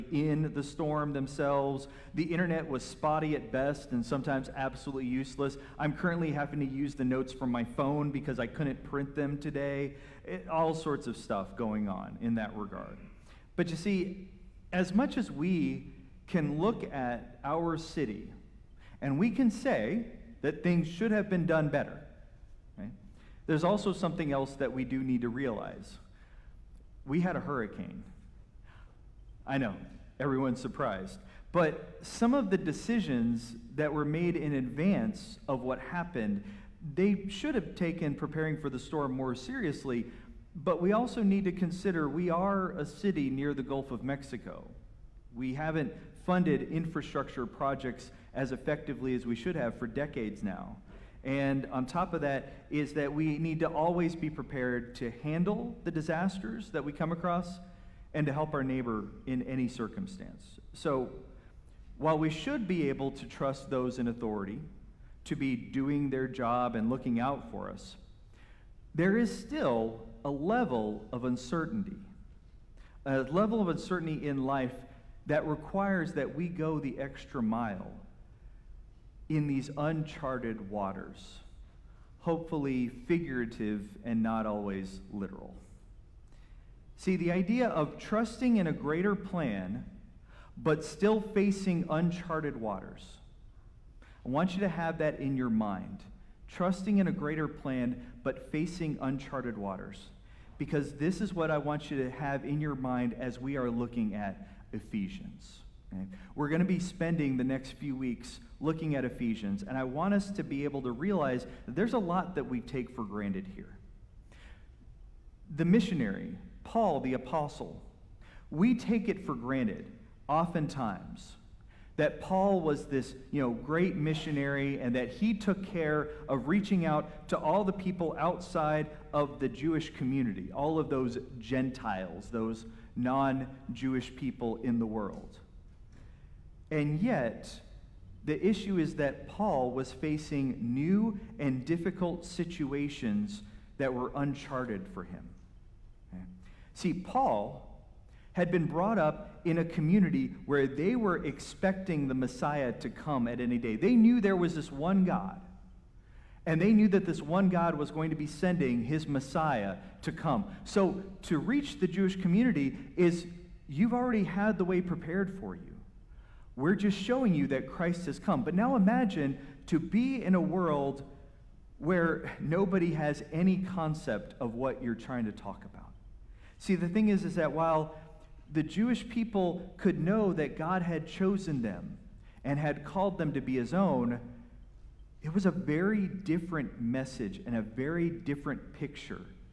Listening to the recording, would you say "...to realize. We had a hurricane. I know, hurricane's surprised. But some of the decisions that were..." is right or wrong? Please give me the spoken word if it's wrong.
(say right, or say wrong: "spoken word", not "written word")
wrong: "everyone", not "hurricane".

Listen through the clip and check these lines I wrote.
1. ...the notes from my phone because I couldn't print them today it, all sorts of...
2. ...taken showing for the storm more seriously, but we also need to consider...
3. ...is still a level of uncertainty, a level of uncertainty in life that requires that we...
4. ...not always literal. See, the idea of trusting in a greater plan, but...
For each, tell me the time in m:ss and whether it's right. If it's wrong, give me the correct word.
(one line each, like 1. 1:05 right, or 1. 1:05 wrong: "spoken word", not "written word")
1. 0:06 right
2. 0:37 wrong: "preparing", not "showing"
3. 1:09 right
4. 1:24 right.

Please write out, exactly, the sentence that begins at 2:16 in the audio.
And yet, the issue is that Paul was facing new and difficult situations that were uncharted for him.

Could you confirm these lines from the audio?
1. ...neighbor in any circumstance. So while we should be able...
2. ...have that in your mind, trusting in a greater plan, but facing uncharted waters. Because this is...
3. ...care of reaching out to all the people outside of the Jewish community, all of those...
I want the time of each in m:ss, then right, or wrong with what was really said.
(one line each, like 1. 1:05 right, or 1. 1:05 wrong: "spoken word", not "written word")
1. 0:58 right
2. 1:34 right
3. 2:05 right.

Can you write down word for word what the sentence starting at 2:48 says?
But now imagine to be in a world where nobody has any concept of what you're trying to talk about.